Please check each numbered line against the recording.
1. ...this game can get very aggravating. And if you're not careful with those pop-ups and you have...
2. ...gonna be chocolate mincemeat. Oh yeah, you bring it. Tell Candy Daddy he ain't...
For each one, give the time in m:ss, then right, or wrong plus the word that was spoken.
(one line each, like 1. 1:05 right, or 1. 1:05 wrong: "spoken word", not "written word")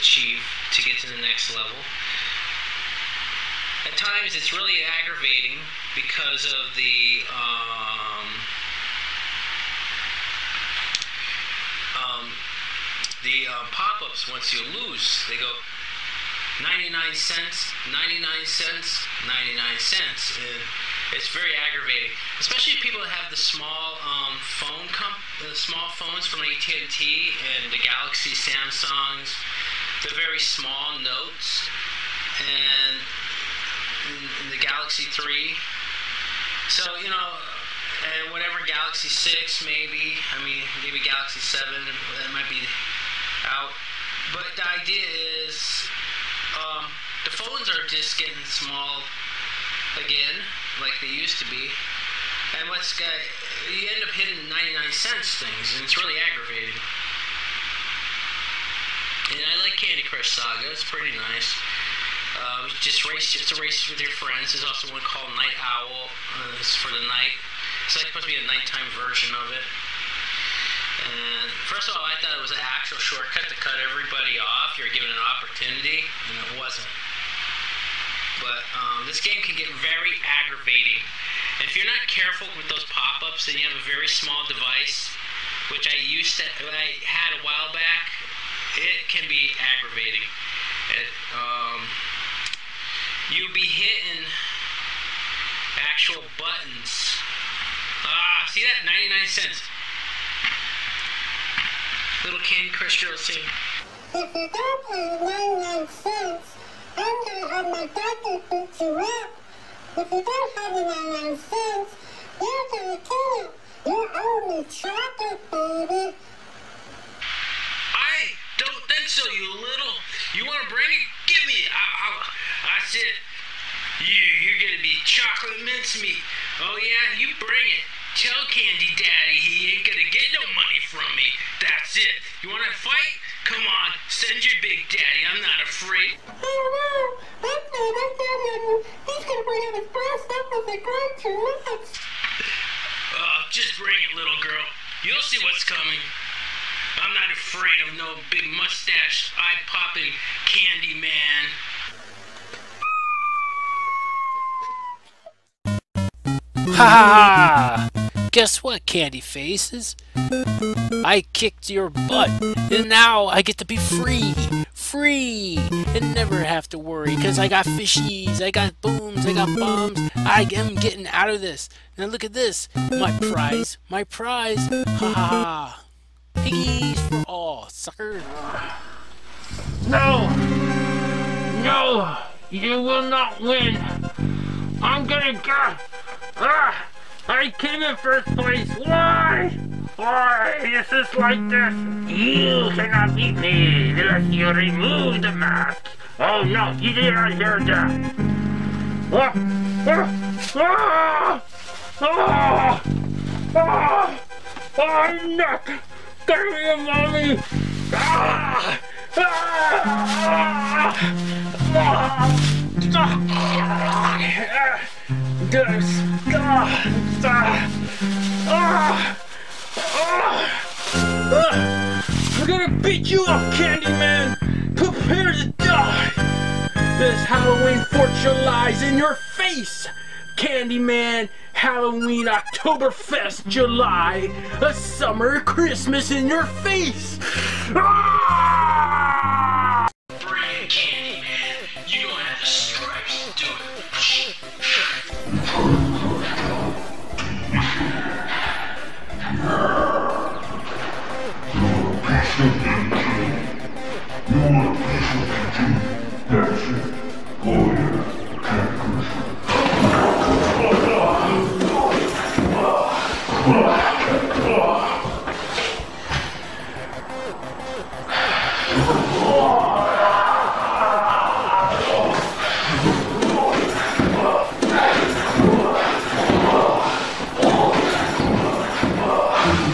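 1. 1:19 right
2. 2:04 right.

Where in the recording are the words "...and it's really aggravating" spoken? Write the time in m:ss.
0:55.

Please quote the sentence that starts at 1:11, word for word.
And first of all, I thought it was an actual shortcut to cut everybody off.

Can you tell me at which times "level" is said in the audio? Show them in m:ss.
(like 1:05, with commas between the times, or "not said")
0:01.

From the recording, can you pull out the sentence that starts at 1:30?
It, um, you'll be hitting actual buttons.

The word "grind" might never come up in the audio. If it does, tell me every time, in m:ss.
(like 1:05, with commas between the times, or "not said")
2:20.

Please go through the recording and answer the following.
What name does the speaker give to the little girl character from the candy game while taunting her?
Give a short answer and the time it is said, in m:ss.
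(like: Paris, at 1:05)
Josie, at 1:43.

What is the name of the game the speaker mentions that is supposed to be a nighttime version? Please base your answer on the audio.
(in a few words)
Night Owl.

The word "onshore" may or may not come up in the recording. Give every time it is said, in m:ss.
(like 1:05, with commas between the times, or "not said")
not said.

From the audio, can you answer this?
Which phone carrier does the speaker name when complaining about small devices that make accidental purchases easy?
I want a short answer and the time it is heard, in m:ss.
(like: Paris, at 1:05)
AT&T, at 0:26.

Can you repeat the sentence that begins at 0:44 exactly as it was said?
But the idea is um, the phones are just getting small again, like they used to be.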